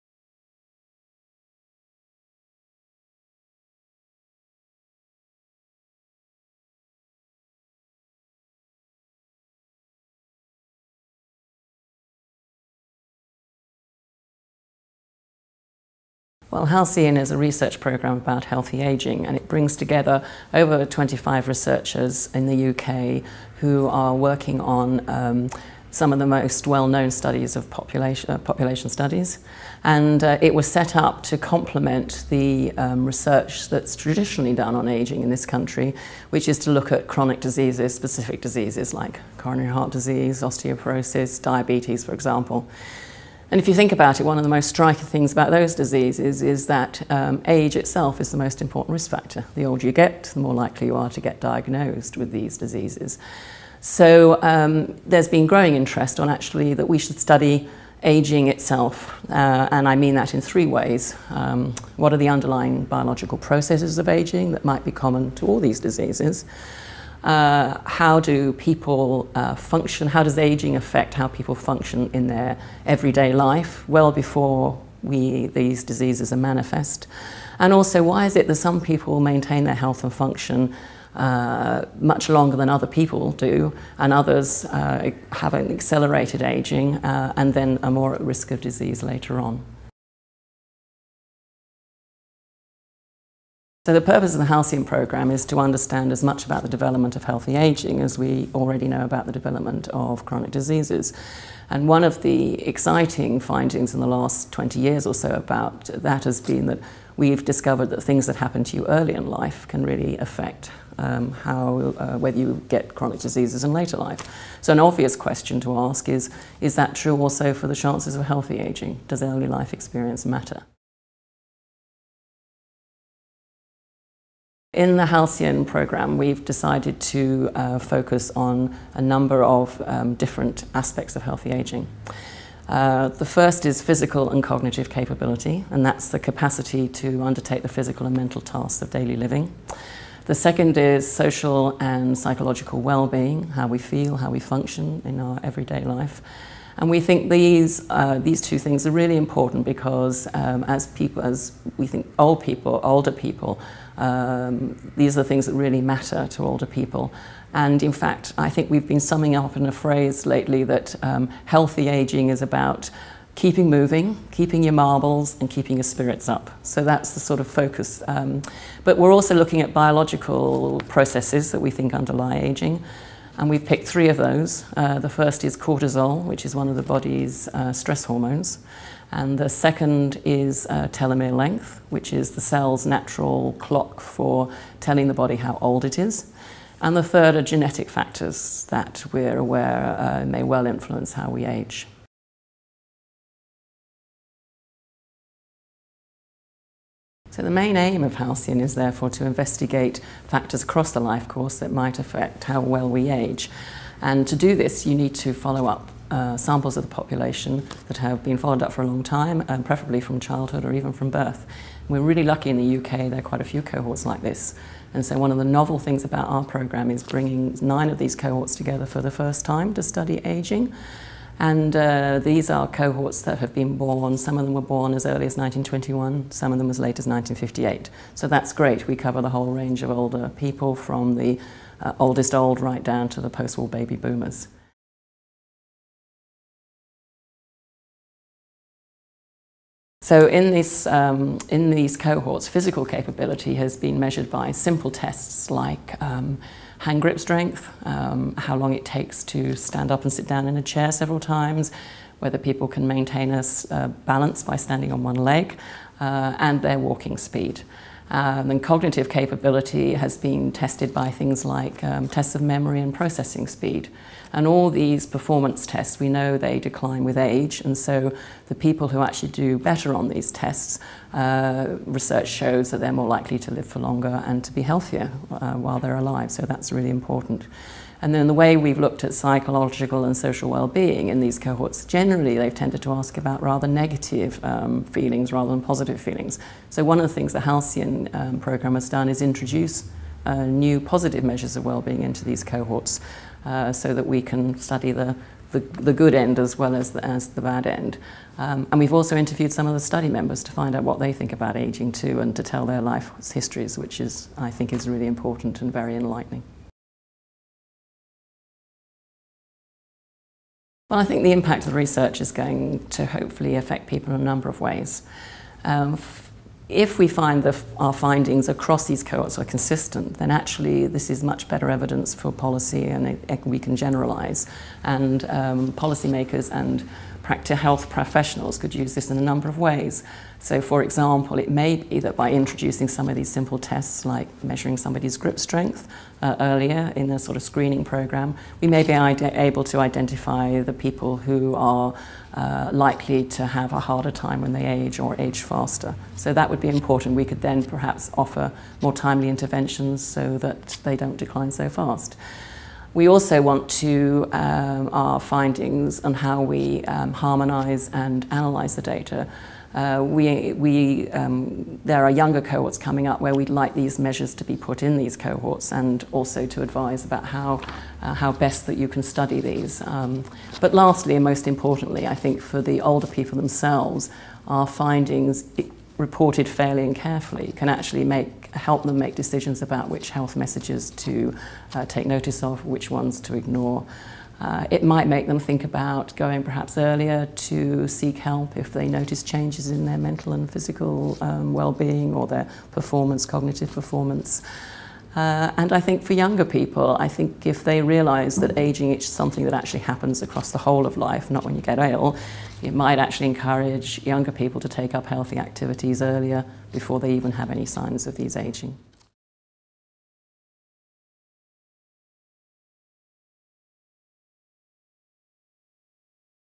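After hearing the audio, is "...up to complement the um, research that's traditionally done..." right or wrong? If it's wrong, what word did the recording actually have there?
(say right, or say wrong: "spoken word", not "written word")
right.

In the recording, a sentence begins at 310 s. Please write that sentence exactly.
Well, I think the impact of the research is going to hopefully affect people in a number of ways.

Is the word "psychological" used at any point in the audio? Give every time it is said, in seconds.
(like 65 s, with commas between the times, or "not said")
142 s, 279 s.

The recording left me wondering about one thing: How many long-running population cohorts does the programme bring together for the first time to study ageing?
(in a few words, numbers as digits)
9.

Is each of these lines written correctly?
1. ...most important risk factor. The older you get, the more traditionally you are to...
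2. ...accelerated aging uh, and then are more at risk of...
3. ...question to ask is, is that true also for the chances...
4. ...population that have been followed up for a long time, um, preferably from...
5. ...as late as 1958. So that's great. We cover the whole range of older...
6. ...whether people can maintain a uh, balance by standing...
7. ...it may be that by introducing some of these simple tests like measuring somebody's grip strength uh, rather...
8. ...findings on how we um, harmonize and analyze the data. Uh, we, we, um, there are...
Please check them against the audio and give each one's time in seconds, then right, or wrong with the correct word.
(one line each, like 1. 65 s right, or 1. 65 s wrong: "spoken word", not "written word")
1. 48 s wrong: "likely", not "traditionally"
2. 85 s right
3. 115 s right
4. 206 s right
5. 226 s right
6. 252 s right
7. 331 s wrong: "earlier", not "rather"
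8. 355 s right.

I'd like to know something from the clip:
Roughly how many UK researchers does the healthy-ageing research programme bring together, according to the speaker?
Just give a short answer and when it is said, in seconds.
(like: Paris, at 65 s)
over 25, at 20 s.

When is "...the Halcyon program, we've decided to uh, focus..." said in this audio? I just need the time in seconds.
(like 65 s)
124 s.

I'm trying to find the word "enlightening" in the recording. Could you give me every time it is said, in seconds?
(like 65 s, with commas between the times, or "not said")
305 s.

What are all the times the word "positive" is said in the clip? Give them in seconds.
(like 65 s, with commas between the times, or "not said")
285 s, 290 s.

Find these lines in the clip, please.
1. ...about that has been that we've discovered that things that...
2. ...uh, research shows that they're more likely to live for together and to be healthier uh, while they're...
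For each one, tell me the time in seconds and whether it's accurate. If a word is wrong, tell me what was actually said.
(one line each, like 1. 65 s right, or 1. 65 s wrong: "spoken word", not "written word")
1. 105 s right
2. 271 s wrong: "longer", not "together".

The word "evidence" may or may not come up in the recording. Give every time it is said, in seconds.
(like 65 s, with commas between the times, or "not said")
321 s.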